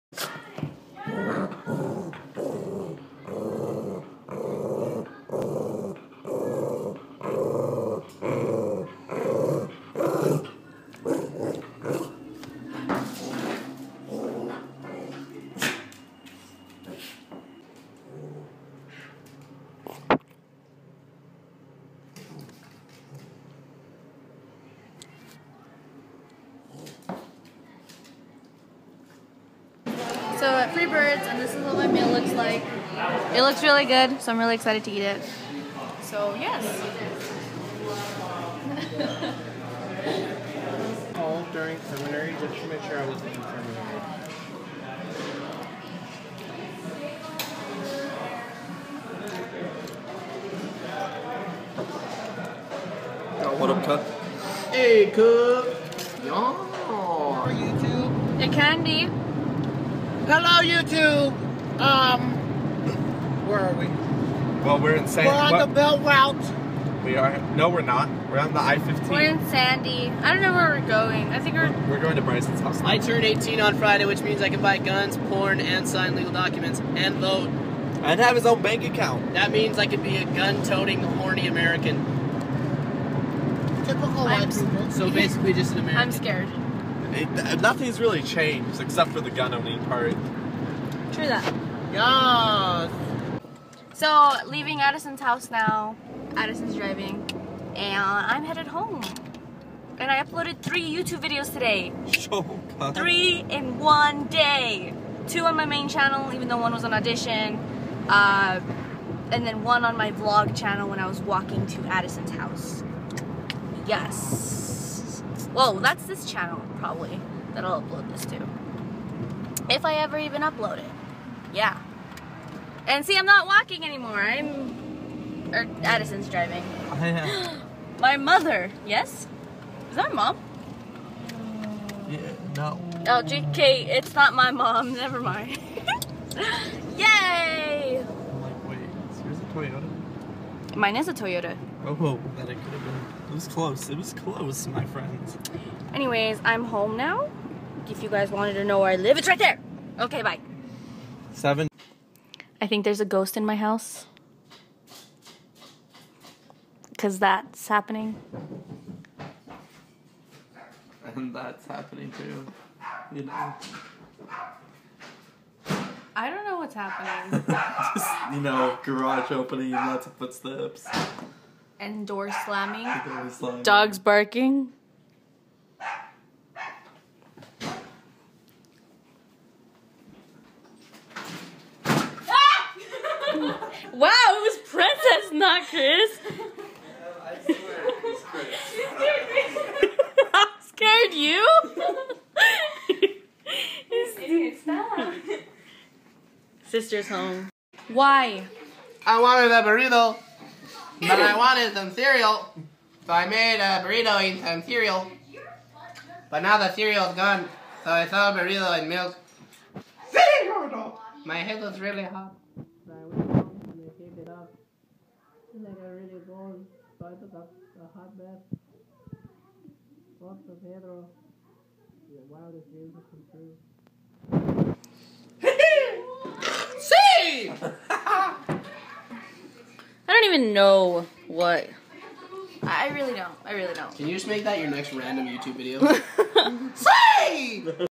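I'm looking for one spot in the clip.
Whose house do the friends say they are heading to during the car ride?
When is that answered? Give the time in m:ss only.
1:12.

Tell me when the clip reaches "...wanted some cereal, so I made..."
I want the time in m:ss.
3:21.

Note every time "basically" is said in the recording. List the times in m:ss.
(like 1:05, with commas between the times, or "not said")
1:25.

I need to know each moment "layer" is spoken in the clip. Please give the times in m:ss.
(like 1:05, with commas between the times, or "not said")
not said.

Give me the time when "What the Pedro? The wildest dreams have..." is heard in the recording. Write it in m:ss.
3:40.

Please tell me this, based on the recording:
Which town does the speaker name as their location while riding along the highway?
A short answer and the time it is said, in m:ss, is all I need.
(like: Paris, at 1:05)
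Sandy, at 1:09.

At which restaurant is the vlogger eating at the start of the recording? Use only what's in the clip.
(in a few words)
Freebirds.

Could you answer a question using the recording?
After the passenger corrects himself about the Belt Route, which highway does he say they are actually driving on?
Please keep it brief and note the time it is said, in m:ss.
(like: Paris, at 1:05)
I-15, at 1:08.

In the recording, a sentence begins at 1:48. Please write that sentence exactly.
Uh, and then one on my vlog channel when I was walking to Addison's house.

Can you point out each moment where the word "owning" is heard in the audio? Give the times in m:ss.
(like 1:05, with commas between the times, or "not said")
1:29.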